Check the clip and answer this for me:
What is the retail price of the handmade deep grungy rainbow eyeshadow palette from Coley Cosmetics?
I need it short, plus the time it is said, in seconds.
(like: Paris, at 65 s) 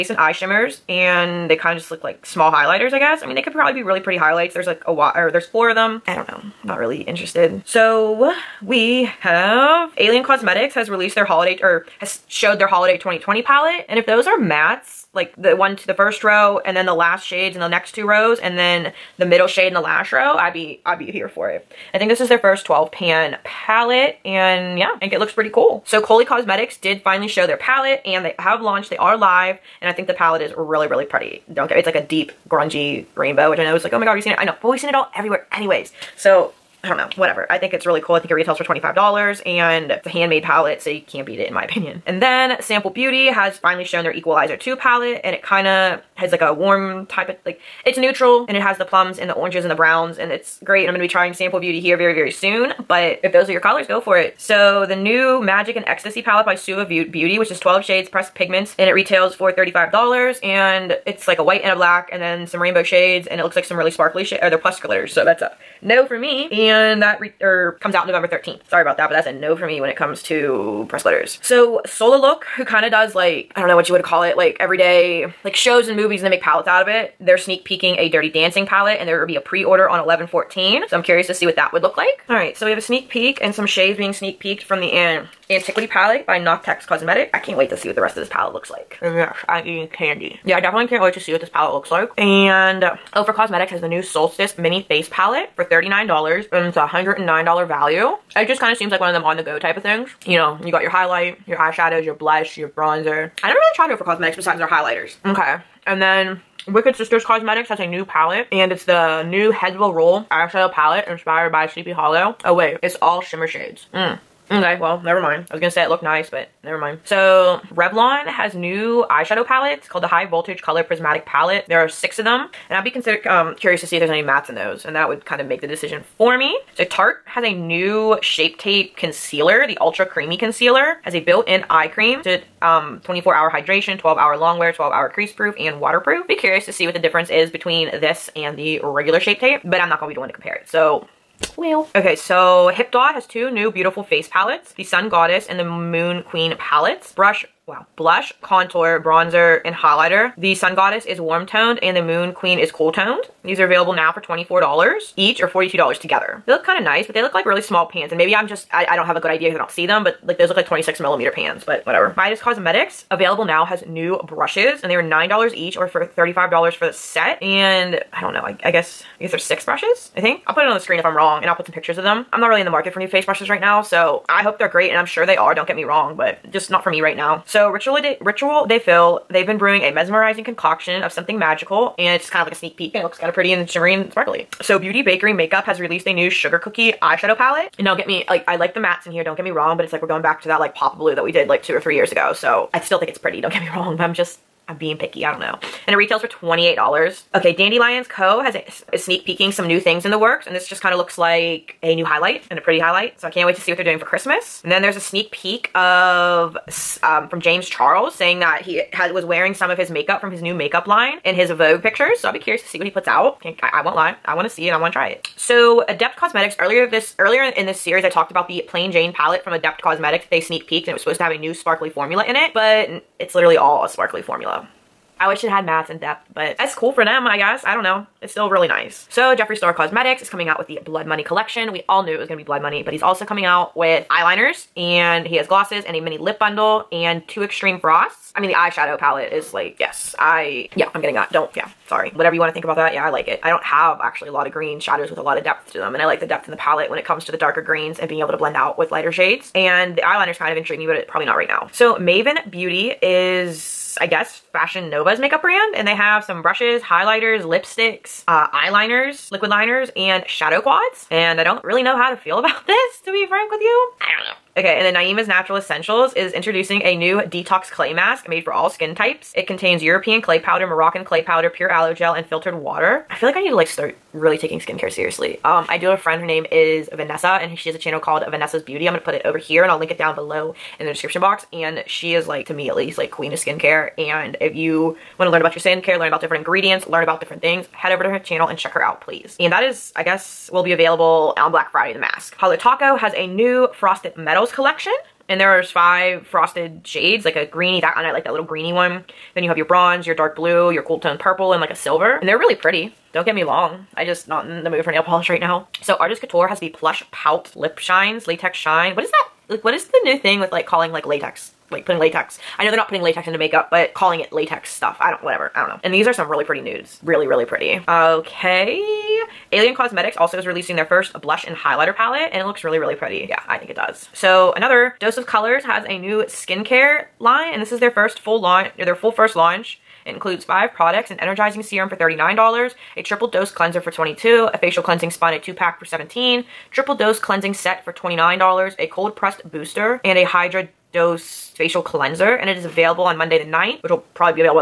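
$25, at 38 s.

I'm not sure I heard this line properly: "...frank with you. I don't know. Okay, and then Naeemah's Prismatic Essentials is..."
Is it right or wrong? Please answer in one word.
wrong.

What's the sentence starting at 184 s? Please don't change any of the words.
So Beauty Bakerie Makeup has released a new sugar cookie eyeshadow palette.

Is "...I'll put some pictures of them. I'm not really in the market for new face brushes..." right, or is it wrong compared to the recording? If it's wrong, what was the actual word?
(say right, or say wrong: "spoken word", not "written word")
right.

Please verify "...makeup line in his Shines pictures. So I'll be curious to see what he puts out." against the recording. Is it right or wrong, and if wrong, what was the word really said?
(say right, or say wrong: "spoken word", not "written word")
wrong: "Vogue", not "Shines".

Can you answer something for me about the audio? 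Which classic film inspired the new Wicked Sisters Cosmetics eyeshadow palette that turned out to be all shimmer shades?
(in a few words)
Sleepy Hollow.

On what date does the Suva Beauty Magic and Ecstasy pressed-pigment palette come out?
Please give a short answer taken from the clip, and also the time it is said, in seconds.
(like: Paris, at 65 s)
November 13th, at 68 s.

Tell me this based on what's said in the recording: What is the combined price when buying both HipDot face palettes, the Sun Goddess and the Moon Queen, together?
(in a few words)
$42.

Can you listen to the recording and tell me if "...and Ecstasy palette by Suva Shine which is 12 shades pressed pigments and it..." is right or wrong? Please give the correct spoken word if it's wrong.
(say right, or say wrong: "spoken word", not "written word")
wrong: "Beauty", not "Shine".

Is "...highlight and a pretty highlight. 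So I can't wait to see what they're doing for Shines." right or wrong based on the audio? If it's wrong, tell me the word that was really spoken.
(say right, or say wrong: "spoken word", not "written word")
wrong: "Christmas", not "Shines".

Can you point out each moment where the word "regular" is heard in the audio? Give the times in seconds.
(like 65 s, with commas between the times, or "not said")
138 s.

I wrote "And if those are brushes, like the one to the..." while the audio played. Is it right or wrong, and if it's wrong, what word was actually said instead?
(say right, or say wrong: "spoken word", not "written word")
wrong: "mattes", not "brushes".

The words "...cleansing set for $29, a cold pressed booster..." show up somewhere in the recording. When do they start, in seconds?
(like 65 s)
337 s.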